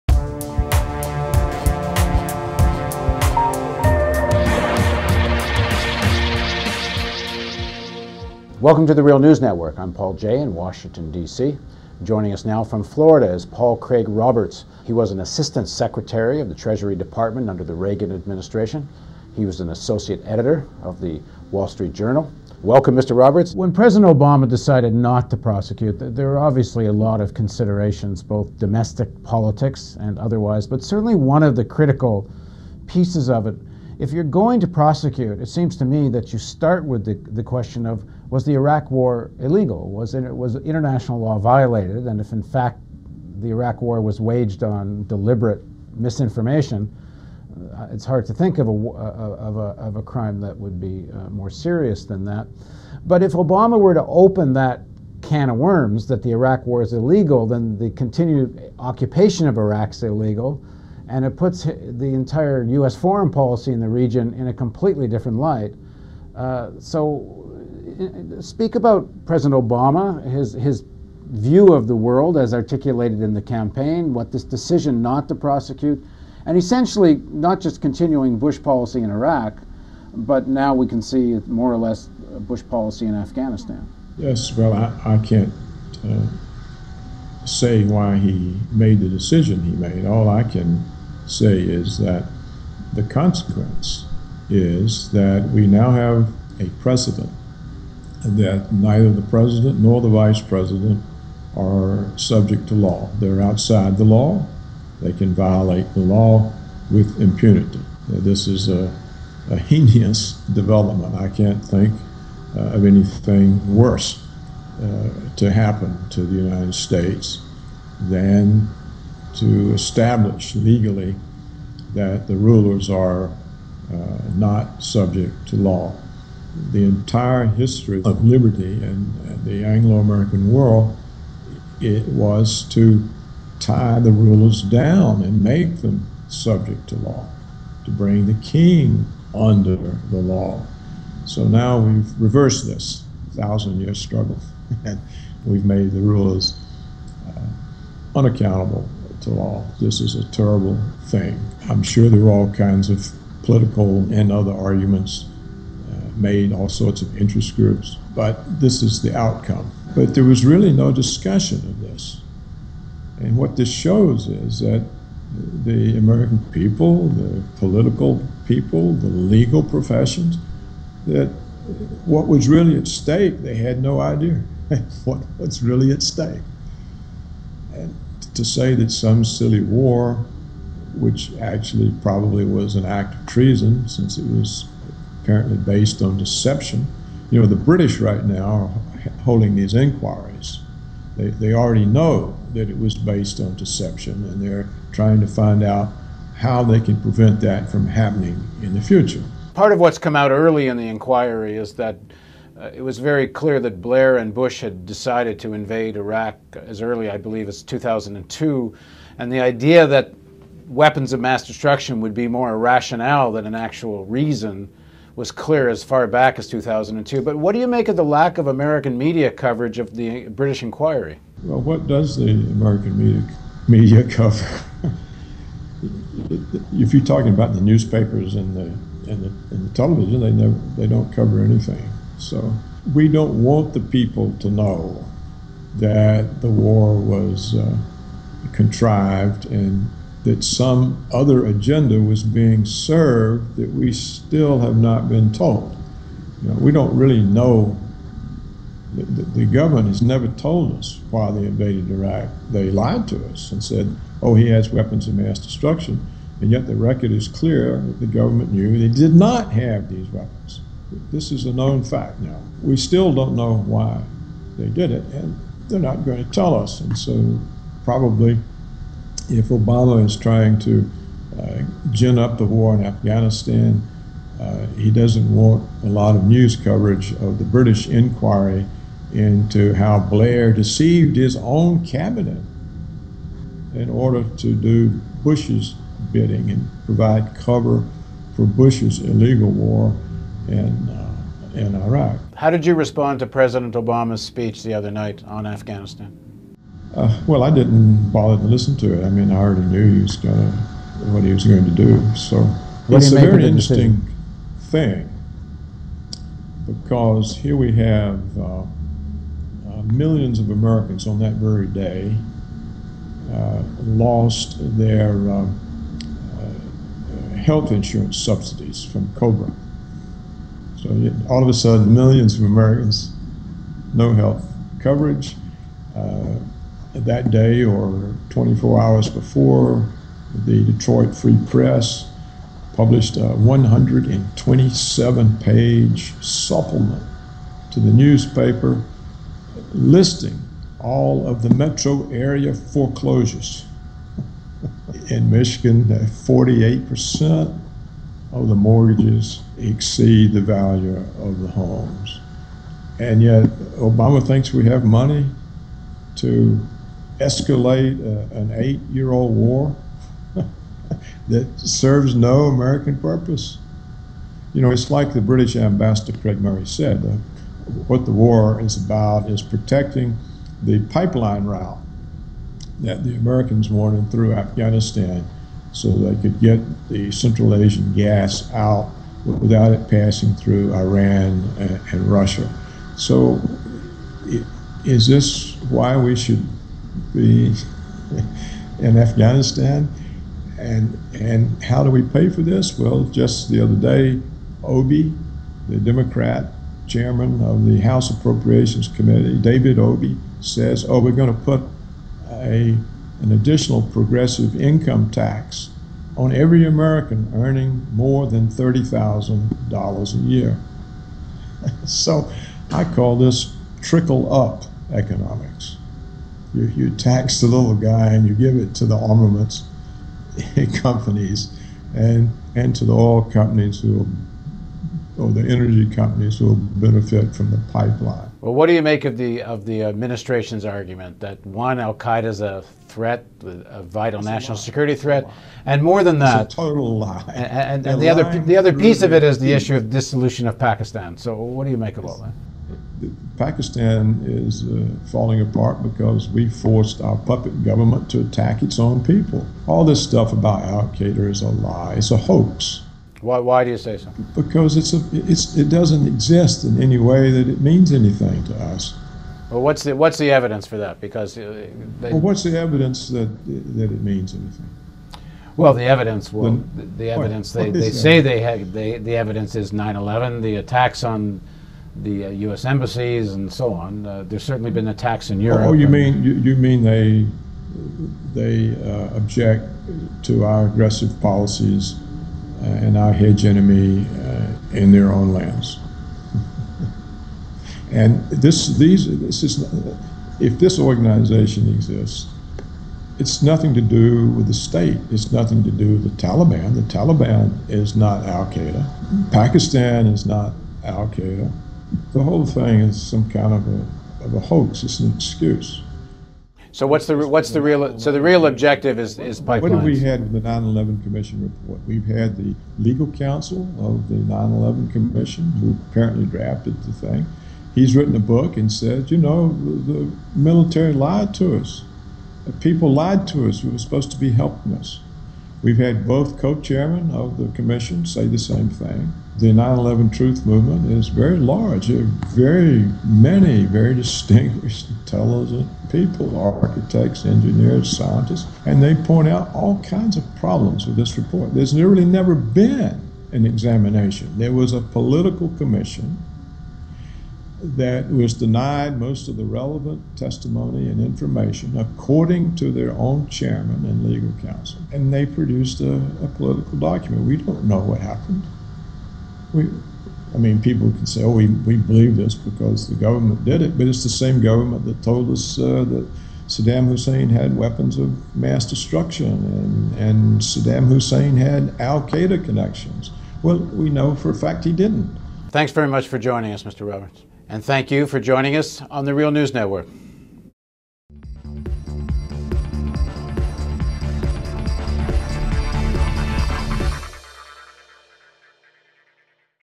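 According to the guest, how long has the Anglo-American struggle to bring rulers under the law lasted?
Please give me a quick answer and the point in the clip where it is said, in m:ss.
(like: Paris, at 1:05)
thousand year, at 2:23.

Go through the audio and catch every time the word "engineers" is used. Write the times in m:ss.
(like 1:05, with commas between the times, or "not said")
8:57.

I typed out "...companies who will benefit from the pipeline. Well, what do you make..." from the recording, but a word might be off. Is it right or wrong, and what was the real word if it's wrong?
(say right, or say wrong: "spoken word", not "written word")
right.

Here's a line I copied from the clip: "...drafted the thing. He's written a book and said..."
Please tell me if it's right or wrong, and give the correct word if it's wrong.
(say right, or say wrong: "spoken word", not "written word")
right.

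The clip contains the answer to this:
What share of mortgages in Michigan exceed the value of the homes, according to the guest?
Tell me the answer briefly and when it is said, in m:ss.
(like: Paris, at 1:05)
48%, at 5:45.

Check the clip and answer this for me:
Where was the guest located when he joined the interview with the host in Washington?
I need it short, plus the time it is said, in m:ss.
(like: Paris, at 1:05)
Florida, at 0:12.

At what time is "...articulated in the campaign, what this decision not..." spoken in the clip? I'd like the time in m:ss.
1:12.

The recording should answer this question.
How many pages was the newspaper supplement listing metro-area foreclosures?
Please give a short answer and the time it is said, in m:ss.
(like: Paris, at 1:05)
127, at 5:33.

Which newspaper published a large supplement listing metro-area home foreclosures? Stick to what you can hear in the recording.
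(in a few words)
Detroit Free Press.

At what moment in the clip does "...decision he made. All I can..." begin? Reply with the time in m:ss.
1:29.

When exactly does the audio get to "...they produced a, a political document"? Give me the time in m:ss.
9:15.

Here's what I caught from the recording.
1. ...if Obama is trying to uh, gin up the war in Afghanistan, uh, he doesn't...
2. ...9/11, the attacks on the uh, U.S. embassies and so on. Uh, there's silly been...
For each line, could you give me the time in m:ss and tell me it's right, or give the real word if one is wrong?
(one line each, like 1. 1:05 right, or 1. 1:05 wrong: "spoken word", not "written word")
1. 4:29 right
2. 7:49 wrong: "certainly", not "silly".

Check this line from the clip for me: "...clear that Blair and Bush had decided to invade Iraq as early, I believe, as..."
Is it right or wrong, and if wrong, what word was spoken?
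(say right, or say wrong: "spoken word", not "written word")
right.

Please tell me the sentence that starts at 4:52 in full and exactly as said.
How did you respond to President Obama's speech the other night on Afghanistan?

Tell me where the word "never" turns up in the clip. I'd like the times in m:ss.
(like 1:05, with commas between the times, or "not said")
3:50, 4:10, 9:02.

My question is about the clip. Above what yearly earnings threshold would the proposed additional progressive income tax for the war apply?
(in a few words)
$30,000.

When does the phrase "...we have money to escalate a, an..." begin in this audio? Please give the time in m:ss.
5:54.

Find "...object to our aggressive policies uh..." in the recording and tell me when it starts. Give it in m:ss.
7:59.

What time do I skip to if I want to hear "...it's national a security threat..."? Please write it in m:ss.
7:14.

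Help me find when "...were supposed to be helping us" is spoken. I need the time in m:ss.
8:43.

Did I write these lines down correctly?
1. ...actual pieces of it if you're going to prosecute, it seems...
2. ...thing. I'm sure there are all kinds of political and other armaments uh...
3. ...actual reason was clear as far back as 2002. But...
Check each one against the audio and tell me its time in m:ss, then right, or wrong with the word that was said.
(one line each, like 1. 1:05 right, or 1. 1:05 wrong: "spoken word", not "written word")
1. 0:31 wrong: "critical", not "actual"
2. 2:31 wrong: "arguments", not "armaments"
3. 3:33 right.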